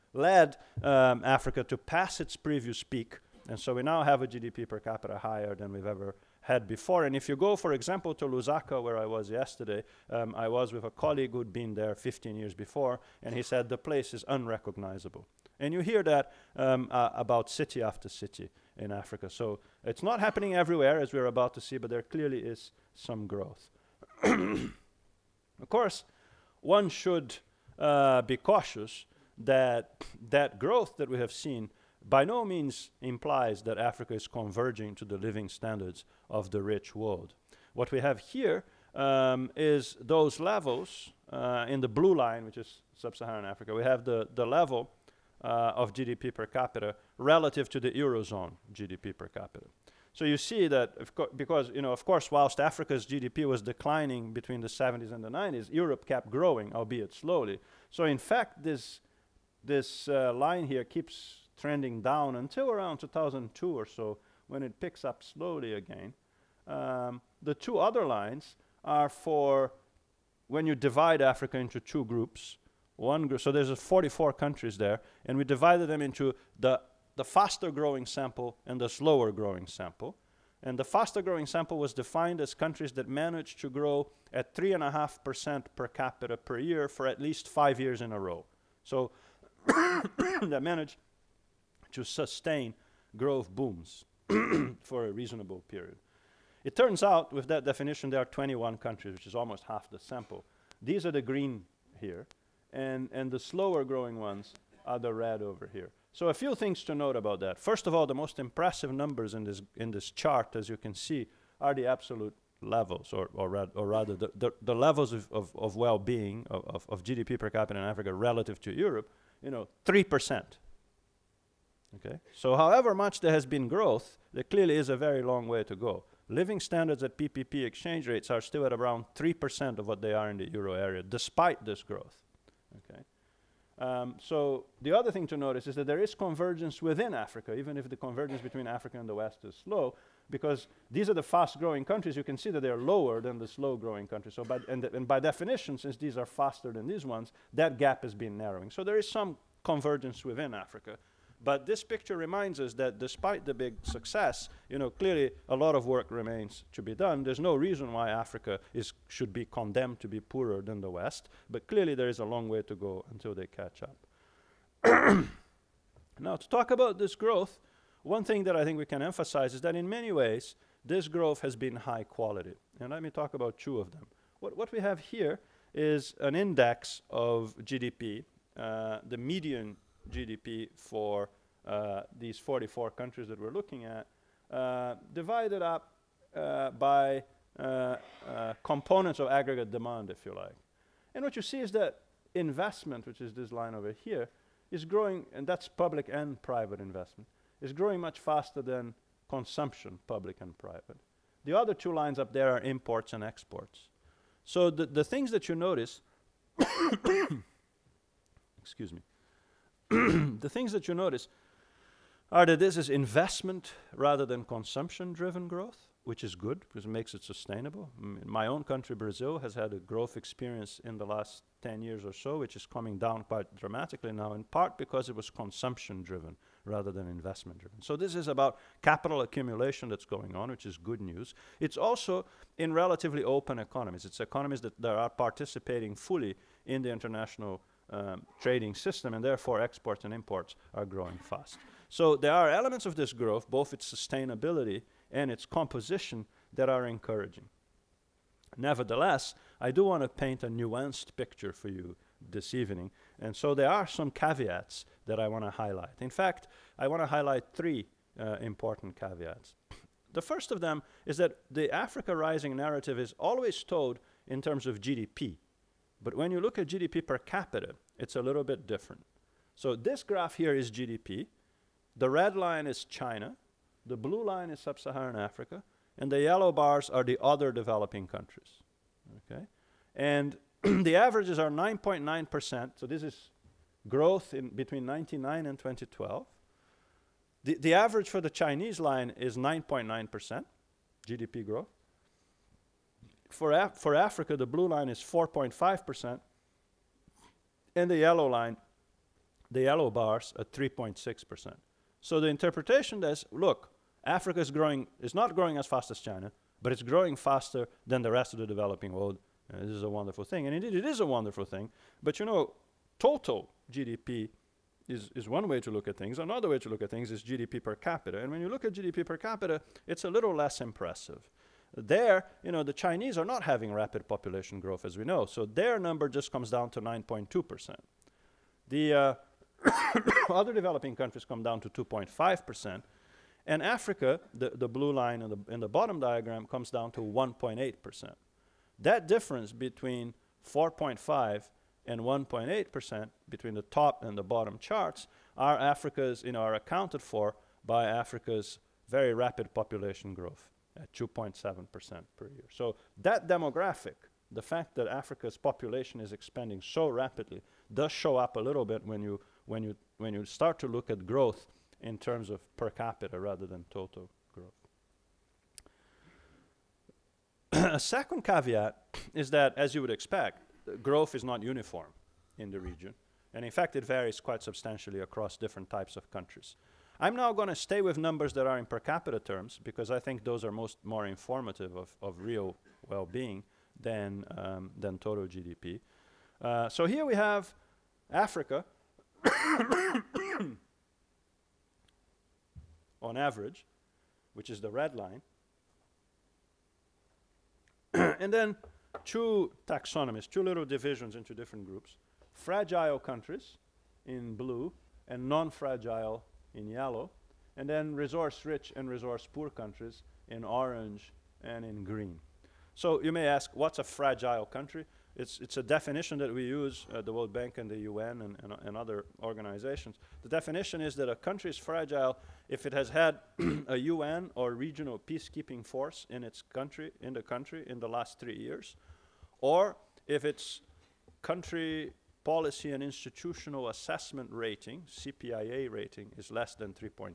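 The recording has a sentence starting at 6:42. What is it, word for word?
Fragile countries in blue and non-fragile in yellow, and then resource-rich and resource-poor countries in orange and in green.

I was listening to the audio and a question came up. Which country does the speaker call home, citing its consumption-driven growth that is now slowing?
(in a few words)
Brazil.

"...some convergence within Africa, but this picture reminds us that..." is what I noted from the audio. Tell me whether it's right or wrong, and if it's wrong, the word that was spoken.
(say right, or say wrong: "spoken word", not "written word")
right.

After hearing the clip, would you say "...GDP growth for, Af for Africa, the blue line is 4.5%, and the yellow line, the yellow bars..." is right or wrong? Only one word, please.
right.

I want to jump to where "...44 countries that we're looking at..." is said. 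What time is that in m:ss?
3:02.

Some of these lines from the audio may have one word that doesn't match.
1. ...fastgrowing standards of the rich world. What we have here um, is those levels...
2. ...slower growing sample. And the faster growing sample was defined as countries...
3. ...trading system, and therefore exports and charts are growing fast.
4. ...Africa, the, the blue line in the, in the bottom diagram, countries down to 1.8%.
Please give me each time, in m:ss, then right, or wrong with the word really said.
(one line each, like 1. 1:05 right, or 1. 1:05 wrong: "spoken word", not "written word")
1. 0:35 wrong: "living", not "fastgrowing"
2. 1:18 right
3. 3:58 wrong: "imports", not "charts"
4. 5:33 wrong: "comes", not "countries".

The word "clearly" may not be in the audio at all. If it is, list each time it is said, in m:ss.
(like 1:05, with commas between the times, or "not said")
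0:22, 2:04, 2:34, 2:41.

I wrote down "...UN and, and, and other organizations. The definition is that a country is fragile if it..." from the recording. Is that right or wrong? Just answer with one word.
right.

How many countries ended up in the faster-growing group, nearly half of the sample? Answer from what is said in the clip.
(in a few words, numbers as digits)
21.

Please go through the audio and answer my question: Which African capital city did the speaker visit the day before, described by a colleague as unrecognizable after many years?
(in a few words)
Lusaka.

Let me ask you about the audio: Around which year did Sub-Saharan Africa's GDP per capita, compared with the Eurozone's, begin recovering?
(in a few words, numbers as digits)
2002.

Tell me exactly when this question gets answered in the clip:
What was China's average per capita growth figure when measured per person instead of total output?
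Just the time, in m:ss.
5:26.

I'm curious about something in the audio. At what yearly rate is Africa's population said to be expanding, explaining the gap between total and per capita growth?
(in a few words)
2.7%.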